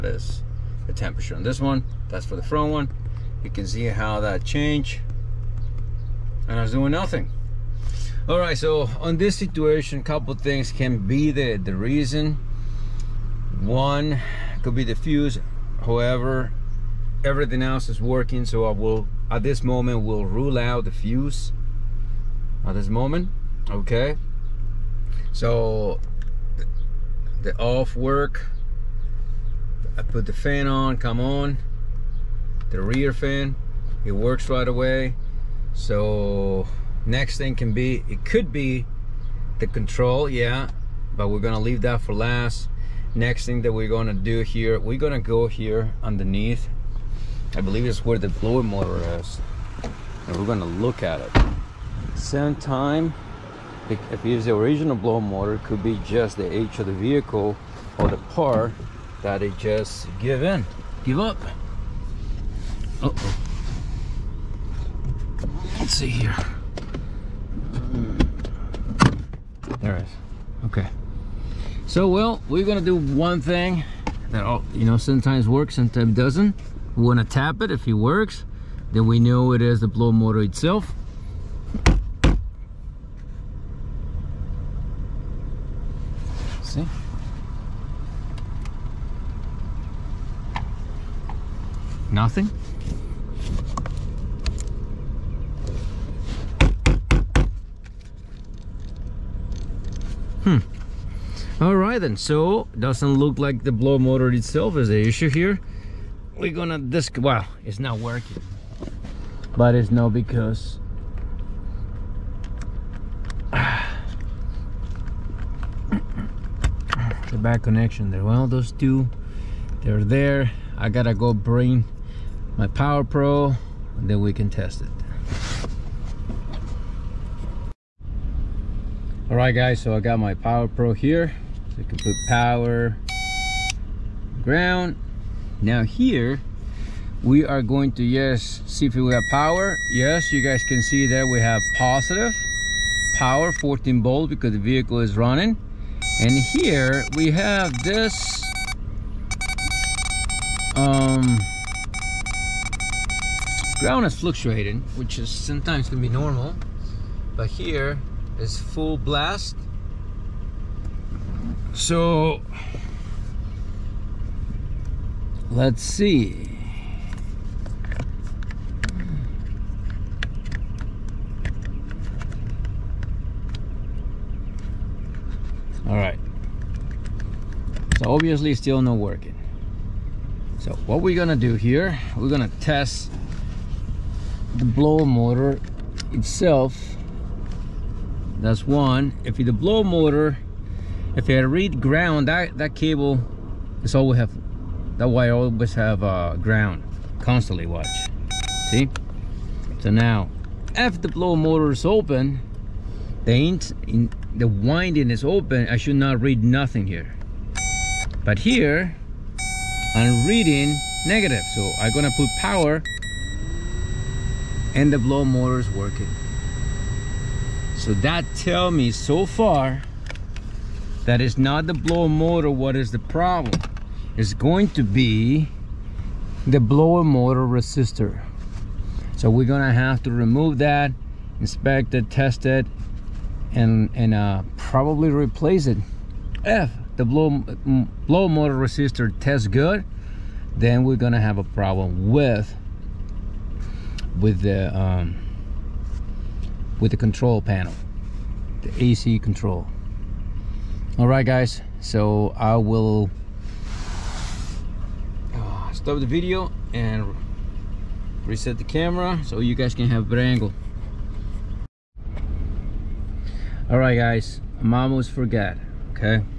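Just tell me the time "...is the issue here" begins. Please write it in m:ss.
1:44.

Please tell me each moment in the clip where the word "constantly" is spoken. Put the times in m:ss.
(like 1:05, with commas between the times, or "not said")
3:17.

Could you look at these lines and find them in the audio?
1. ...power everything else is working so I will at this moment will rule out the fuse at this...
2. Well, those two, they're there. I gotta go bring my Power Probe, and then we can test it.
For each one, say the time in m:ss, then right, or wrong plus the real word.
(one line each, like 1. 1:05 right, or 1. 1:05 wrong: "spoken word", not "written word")
1. 0:15 wrong: "however", not "power"
2. 1:58 right.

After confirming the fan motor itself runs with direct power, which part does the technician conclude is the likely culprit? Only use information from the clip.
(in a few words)
Blower motor resistor.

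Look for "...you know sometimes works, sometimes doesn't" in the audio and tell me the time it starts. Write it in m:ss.
1:14.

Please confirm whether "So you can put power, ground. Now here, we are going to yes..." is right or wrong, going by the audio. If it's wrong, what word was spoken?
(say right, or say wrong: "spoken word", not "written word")
right.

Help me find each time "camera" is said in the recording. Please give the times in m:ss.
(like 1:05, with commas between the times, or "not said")
4:18.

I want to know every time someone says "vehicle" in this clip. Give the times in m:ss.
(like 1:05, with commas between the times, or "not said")
0:56, 2:24.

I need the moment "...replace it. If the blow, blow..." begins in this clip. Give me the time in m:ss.
3:55.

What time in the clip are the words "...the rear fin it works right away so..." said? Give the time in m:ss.
0:32.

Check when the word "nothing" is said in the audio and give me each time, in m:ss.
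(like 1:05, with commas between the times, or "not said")
0:06, 1:32, 3:26.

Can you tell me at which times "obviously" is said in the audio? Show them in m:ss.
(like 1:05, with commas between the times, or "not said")
2:58.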